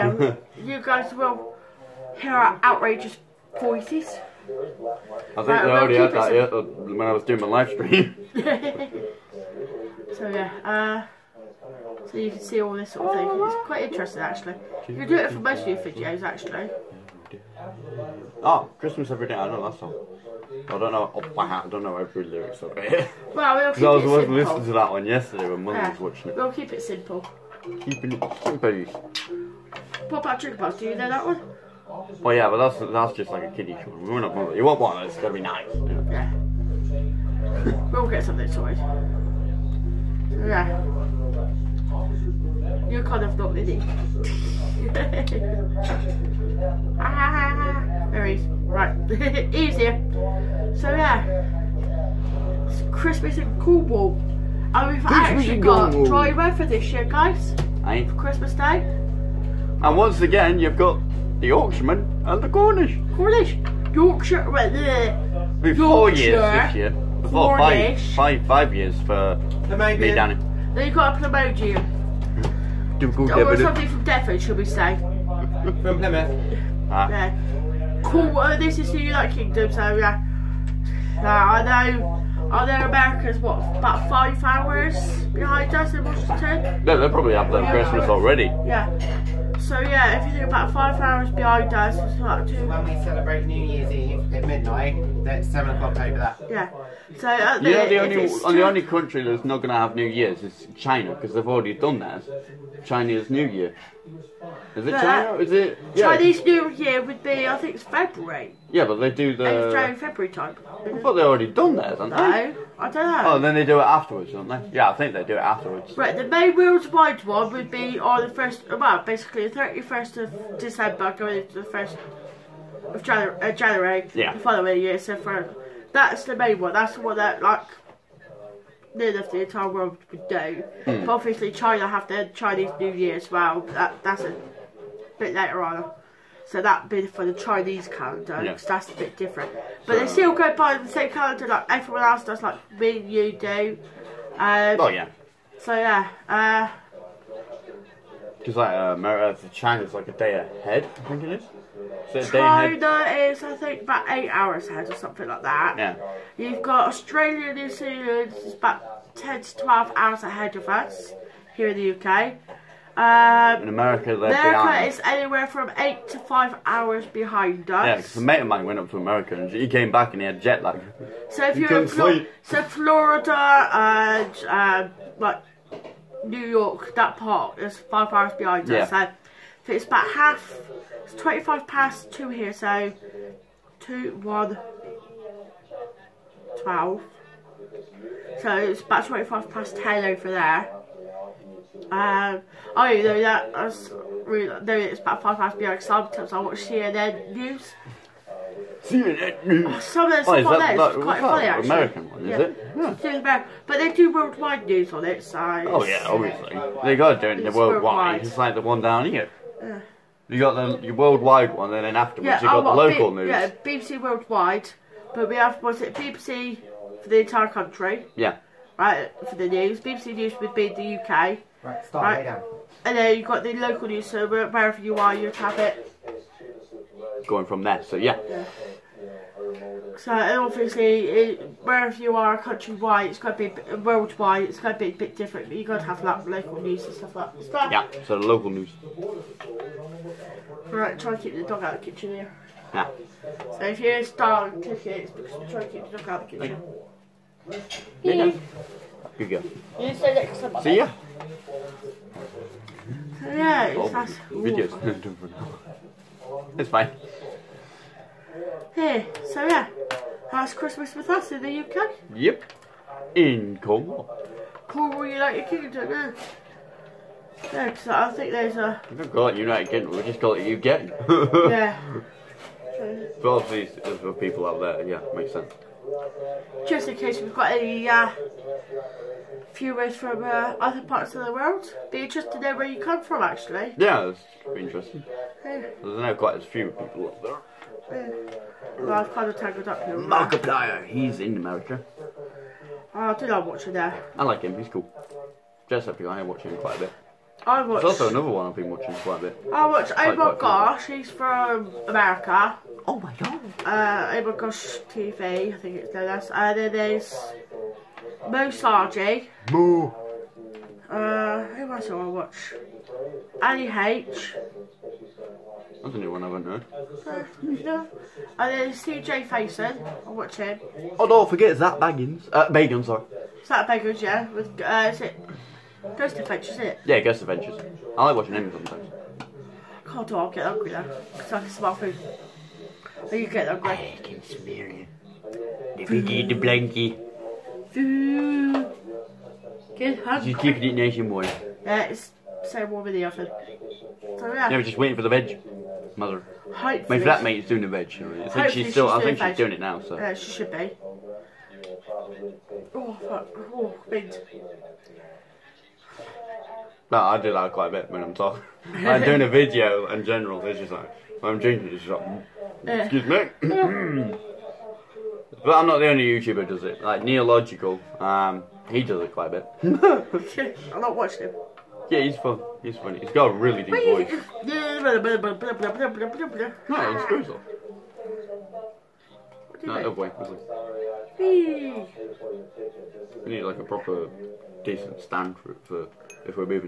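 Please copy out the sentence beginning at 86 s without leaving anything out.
No, they probably have their yeah.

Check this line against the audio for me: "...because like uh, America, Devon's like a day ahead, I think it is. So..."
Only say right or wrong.
wrong.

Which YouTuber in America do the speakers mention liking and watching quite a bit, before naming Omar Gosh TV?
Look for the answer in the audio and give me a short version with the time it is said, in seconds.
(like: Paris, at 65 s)
Markiplier, at 289 s.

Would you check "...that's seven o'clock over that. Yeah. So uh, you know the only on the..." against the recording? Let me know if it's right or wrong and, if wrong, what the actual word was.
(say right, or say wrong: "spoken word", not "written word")
right.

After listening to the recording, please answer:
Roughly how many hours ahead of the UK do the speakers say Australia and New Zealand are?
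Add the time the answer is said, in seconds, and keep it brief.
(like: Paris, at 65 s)
10 to 12, at 159 s.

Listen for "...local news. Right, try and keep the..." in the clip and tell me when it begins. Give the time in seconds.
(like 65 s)
238 s.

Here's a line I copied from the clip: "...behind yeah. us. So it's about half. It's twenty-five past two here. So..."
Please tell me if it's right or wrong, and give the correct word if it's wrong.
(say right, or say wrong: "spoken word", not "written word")
right.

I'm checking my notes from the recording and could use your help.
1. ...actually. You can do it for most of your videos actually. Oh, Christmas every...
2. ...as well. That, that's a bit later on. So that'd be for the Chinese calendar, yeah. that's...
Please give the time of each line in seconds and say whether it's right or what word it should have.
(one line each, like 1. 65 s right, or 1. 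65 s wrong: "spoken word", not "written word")
1. 14 s right
2. 133 s right.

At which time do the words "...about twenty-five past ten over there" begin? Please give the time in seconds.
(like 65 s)
188 s.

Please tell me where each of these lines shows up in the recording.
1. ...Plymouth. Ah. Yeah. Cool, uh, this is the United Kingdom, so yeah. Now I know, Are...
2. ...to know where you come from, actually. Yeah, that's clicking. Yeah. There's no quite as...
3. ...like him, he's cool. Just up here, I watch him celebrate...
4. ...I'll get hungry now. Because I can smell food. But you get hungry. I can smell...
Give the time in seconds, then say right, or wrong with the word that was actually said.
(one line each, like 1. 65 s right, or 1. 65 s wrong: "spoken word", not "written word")
1. 75 s right
2. 282 s wrong: "interesting", not "clicking"
3. 294 s wrong: "quite", not "celebrate"
4. 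330 s right.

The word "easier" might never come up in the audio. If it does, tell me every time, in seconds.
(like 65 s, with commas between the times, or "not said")
49 s.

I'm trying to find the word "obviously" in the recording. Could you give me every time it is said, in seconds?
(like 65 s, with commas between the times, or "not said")
131 s, 206 s, 230 s, 273 s.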